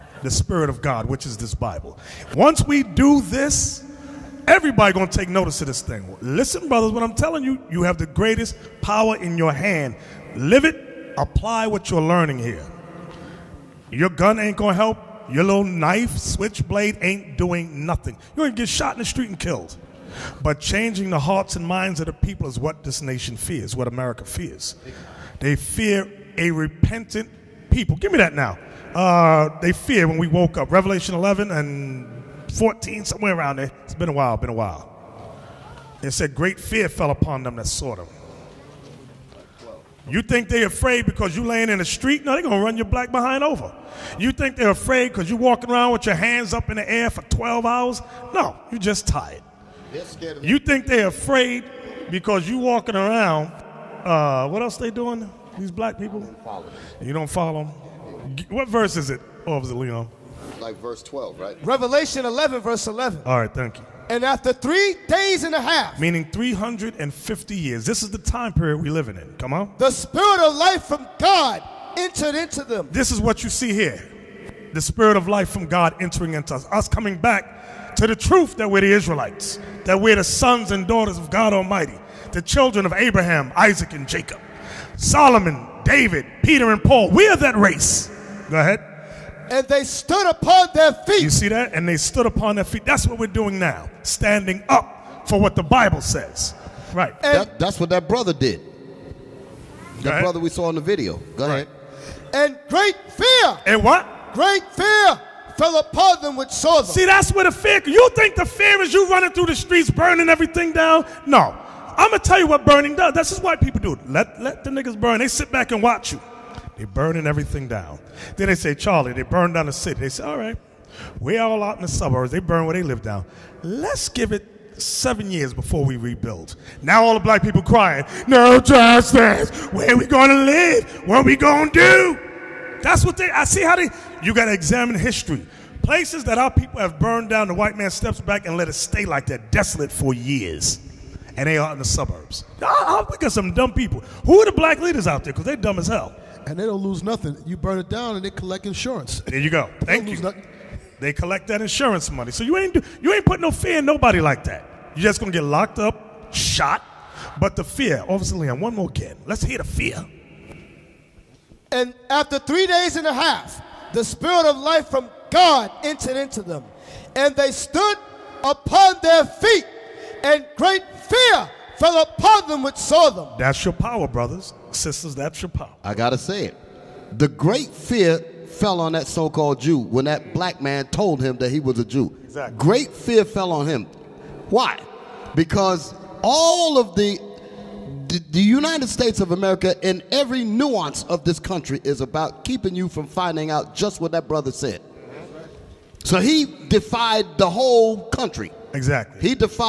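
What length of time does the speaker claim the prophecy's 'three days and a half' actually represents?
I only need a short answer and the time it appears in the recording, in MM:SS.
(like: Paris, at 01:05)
350 years, at 01:06.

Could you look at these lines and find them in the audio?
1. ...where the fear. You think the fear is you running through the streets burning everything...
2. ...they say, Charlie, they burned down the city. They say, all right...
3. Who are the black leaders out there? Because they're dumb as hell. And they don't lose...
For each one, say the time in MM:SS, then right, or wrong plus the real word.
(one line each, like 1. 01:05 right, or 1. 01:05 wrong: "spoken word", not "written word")
1. 01:47 right
2. 01:58 right
3. 02:24 right.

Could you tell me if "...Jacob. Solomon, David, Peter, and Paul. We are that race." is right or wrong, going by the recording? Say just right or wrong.
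right.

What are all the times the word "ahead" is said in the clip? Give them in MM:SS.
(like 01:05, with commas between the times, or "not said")
01:28, 01:41.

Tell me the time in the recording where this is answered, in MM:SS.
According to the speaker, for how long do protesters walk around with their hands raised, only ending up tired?
00:47.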